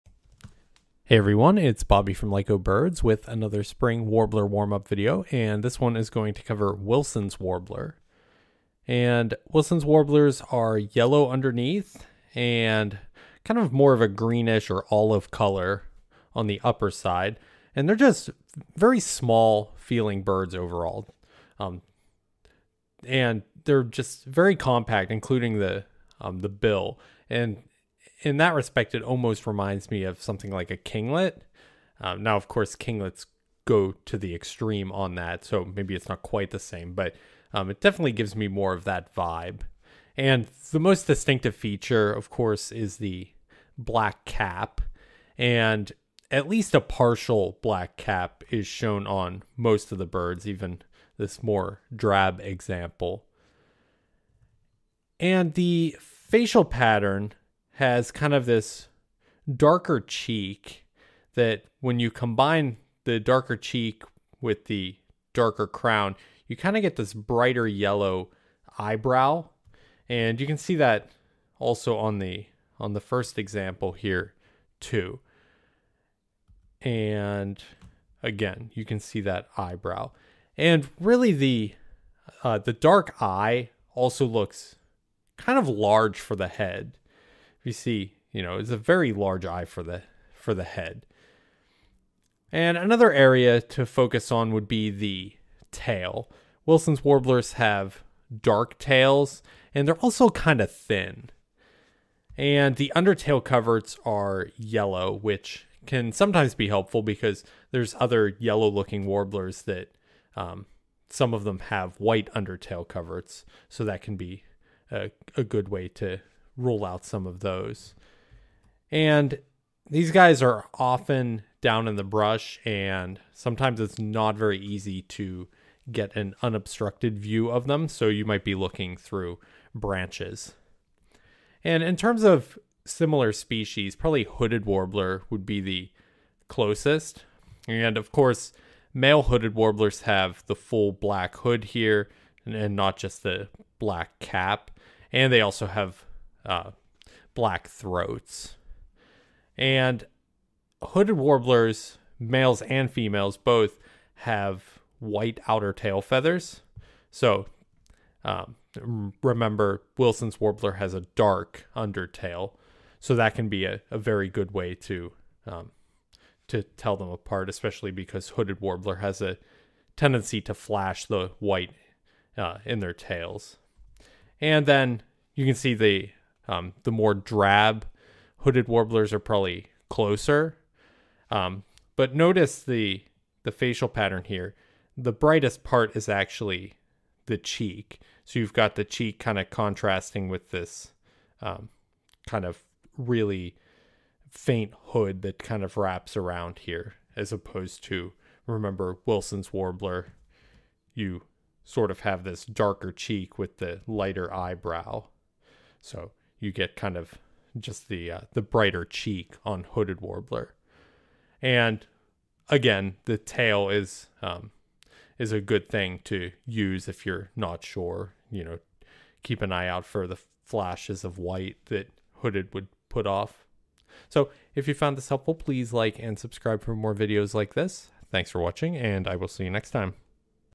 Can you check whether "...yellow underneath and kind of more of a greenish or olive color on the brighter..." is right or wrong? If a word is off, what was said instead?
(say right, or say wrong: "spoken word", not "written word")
wrong: "upper", not "brighter".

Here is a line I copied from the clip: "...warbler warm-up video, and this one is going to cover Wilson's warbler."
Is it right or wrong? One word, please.
right.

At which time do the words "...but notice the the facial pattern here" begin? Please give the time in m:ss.
3:01.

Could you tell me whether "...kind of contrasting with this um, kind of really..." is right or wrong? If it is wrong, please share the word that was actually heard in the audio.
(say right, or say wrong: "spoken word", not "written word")
right.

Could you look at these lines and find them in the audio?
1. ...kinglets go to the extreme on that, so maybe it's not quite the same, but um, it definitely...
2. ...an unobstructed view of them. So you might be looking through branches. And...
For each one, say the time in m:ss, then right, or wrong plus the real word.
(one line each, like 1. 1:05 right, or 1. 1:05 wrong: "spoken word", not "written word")
1. 0:32 right
2. 2:06 right.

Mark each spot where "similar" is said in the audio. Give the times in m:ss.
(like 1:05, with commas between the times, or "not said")
2:12.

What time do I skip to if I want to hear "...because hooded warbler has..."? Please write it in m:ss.
2:47.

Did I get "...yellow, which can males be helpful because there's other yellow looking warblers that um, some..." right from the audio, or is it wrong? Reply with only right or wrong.
wrong.